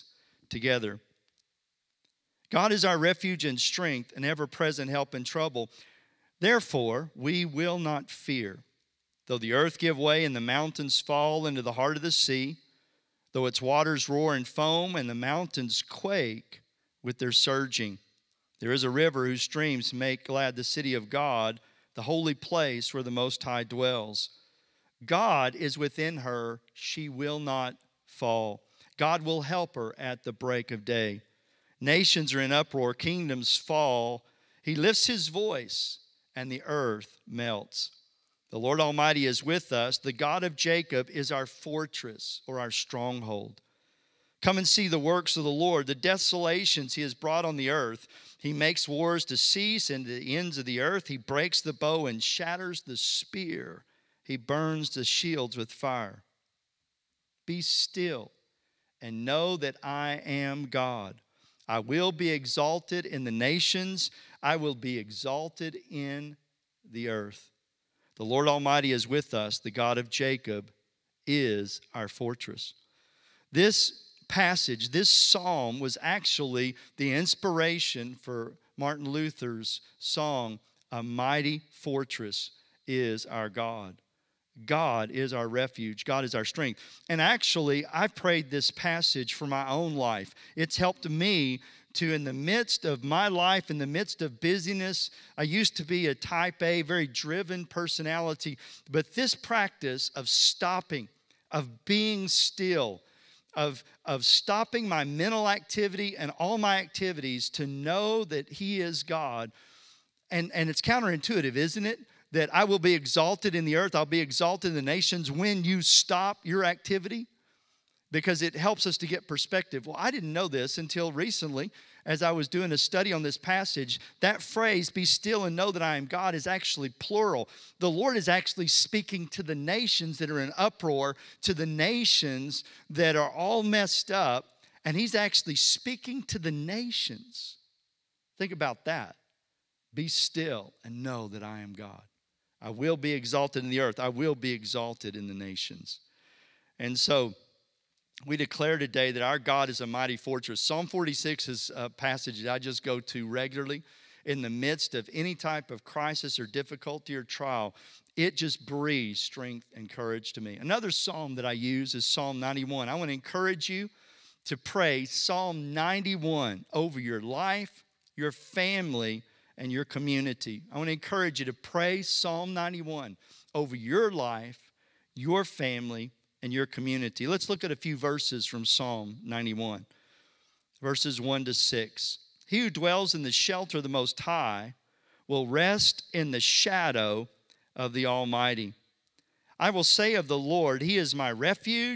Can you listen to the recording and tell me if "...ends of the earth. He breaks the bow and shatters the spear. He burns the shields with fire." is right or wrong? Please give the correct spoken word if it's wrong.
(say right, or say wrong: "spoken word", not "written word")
right.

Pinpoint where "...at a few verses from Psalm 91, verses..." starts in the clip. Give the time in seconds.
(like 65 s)
177 s.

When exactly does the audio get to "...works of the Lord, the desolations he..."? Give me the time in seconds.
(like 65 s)
44 s.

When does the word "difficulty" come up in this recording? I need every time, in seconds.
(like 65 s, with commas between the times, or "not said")
156 s.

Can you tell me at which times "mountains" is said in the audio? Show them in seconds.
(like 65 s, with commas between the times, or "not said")
10 s, 15 s.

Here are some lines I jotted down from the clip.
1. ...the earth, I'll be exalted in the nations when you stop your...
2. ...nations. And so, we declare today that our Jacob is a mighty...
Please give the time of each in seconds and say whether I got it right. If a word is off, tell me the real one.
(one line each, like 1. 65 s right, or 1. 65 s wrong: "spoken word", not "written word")
1. 113 s right
2. 145 s wrong: "God", not "Jacob".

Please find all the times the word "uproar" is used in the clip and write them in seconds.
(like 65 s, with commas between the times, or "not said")
32 s, 130 s.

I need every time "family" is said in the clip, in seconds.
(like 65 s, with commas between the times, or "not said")
168 s, 175 s.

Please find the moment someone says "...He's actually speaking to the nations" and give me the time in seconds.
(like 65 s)
134 s.